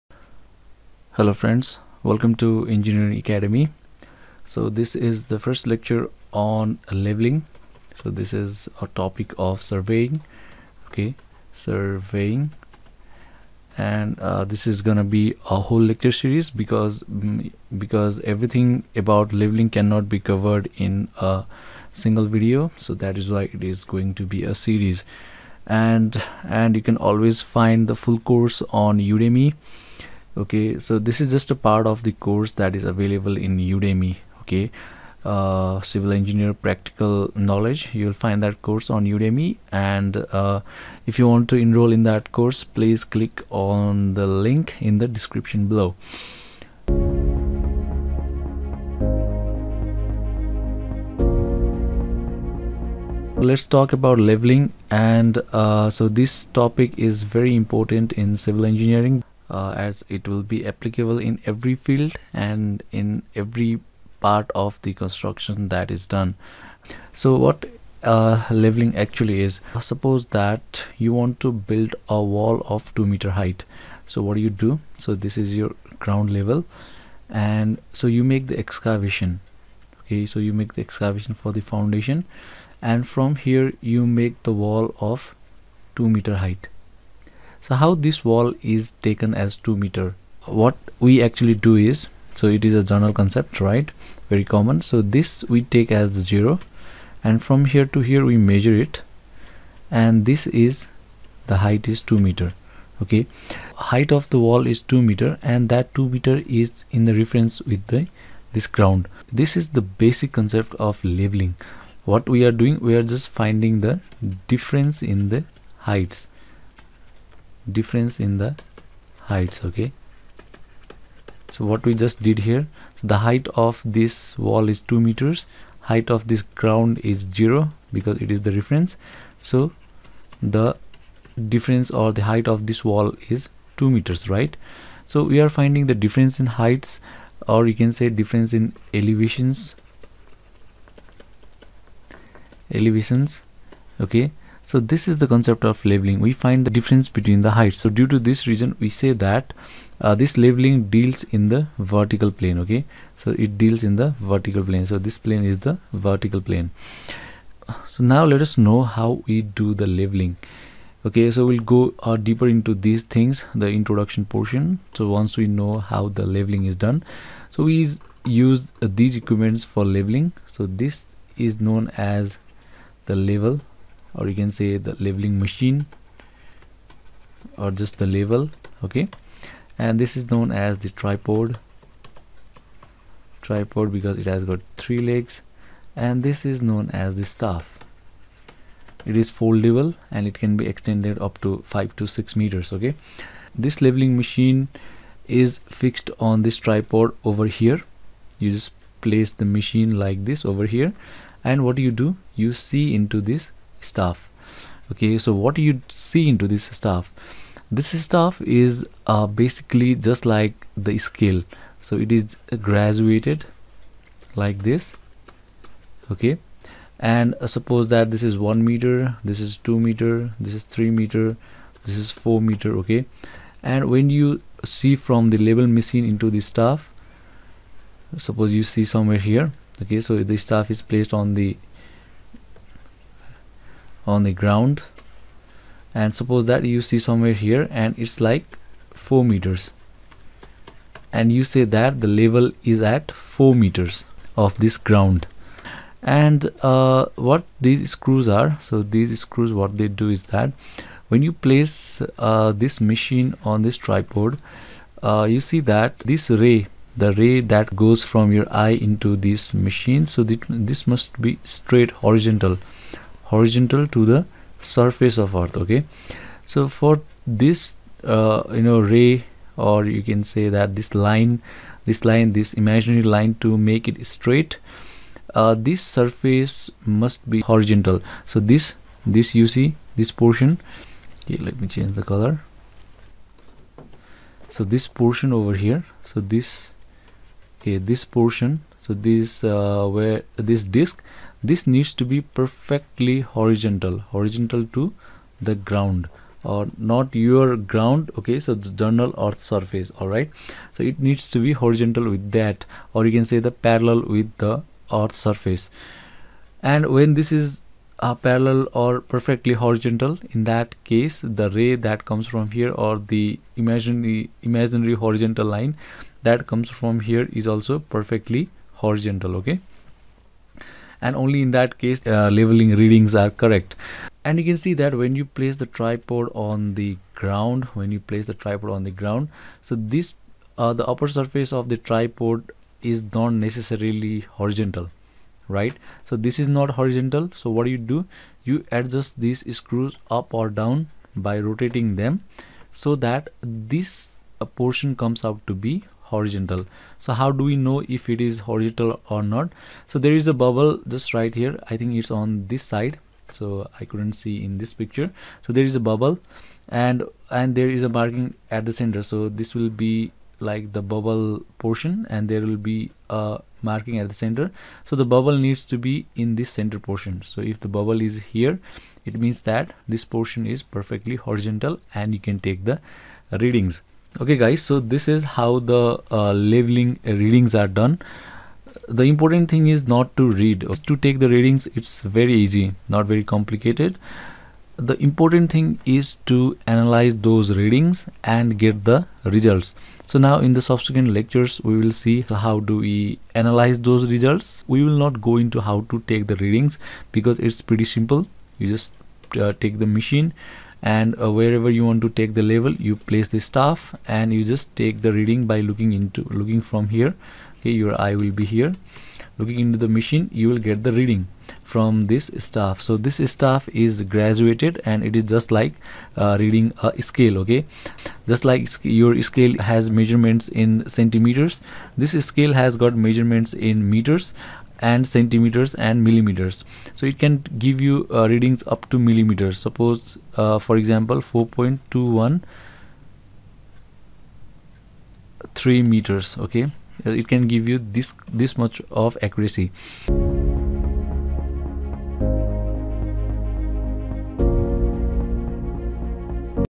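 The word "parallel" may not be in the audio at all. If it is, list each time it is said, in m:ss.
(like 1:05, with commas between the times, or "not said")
5:03, 5:08.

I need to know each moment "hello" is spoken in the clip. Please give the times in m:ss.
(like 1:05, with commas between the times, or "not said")
0:01.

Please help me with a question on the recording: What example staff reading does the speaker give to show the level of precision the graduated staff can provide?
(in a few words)
4.21 meters.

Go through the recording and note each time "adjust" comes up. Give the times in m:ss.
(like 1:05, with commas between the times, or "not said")
5:38.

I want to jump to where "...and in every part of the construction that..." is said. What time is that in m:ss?
1:02.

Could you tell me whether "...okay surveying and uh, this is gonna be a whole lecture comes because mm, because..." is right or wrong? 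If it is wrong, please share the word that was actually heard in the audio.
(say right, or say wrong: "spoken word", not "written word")
wrong: "series", not "comes".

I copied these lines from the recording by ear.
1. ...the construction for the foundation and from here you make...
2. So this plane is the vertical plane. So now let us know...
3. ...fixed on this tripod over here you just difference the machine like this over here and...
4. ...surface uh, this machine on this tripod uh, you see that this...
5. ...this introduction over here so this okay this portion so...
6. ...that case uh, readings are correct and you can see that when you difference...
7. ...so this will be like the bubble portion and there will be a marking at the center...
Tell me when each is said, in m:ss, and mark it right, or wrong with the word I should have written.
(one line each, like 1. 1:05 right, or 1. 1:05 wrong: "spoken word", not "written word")
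1. 1:20 wrong: "excavation", not "construction"
2. 2:34 right
3. 3:15 wrong: "place", not "difference"
4. 4:11 wrong: "place", not "surface"
5. 4:44 wrong: "portion", not "introduction"
6. 5:21 wrong: "place", not "difference"
7. 5:59 right.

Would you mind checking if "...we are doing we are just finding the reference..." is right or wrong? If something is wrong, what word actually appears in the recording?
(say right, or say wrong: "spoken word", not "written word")
wrong: "difference", not "reference".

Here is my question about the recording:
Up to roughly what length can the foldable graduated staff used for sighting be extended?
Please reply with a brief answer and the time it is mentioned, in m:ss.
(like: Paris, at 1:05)
5 to 6 meters, at 3:11.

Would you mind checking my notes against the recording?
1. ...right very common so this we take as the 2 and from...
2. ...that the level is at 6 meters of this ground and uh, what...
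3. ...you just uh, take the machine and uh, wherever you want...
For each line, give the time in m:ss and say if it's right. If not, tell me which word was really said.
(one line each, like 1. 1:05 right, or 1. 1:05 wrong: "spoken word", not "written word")
1. 1:33 wrong: "0", not "2"
2. 4:01 wrong: "4", not "6"
3. 6:38 right.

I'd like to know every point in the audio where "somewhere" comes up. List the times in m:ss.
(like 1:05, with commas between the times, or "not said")
3:48, 3:57.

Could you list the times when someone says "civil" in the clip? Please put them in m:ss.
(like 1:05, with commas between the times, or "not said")
0:35, 0:58.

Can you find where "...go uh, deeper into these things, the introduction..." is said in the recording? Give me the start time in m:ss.
2:41.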